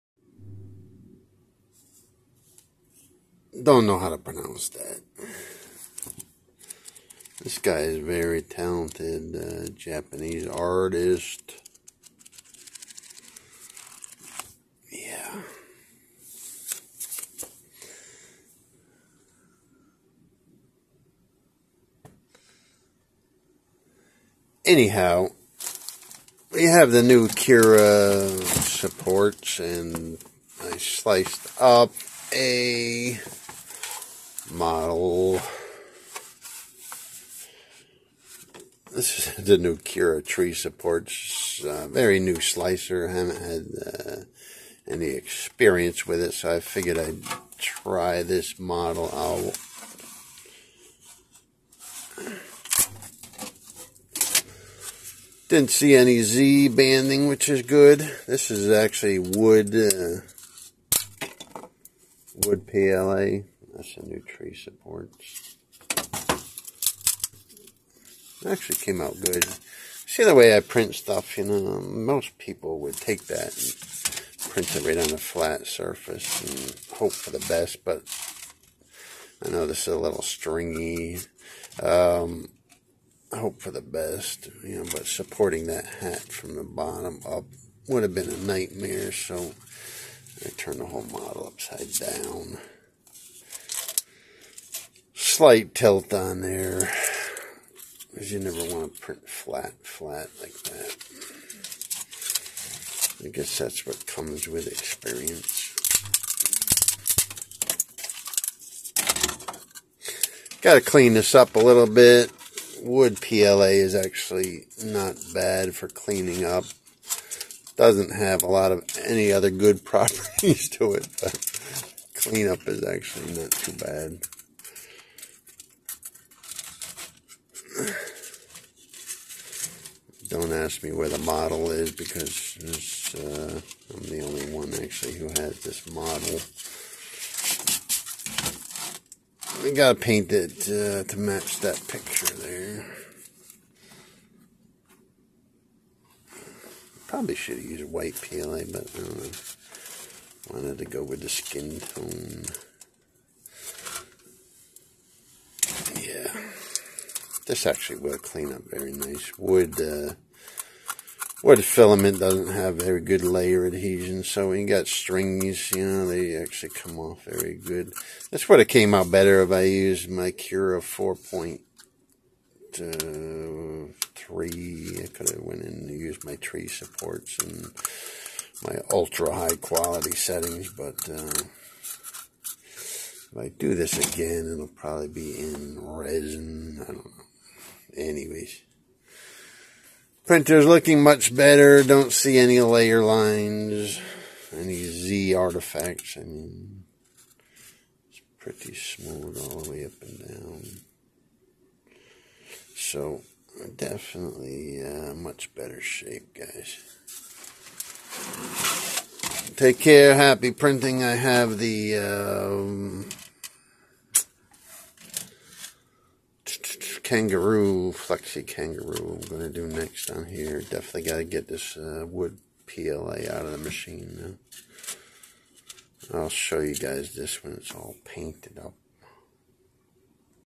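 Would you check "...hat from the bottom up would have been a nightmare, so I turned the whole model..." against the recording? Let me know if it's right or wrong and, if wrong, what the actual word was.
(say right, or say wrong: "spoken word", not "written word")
right.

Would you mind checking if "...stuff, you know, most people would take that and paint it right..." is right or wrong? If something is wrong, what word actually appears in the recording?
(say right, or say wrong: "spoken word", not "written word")
wrong: "print", not "paint".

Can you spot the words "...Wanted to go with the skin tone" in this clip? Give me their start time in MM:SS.
02:30.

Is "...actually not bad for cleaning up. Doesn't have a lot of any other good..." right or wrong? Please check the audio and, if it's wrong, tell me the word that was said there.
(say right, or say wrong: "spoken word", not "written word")
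right.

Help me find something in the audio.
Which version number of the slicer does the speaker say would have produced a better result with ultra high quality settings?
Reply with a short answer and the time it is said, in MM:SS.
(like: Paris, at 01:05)
Cura 4.3, at 02:50.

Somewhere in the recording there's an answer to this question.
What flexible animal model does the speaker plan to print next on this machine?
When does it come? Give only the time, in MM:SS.
03:37.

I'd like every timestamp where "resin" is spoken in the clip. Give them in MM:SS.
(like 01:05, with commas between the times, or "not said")
03:05.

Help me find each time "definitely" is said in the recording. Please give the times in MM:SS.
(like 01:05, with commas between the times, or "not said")
03:23, 03:40.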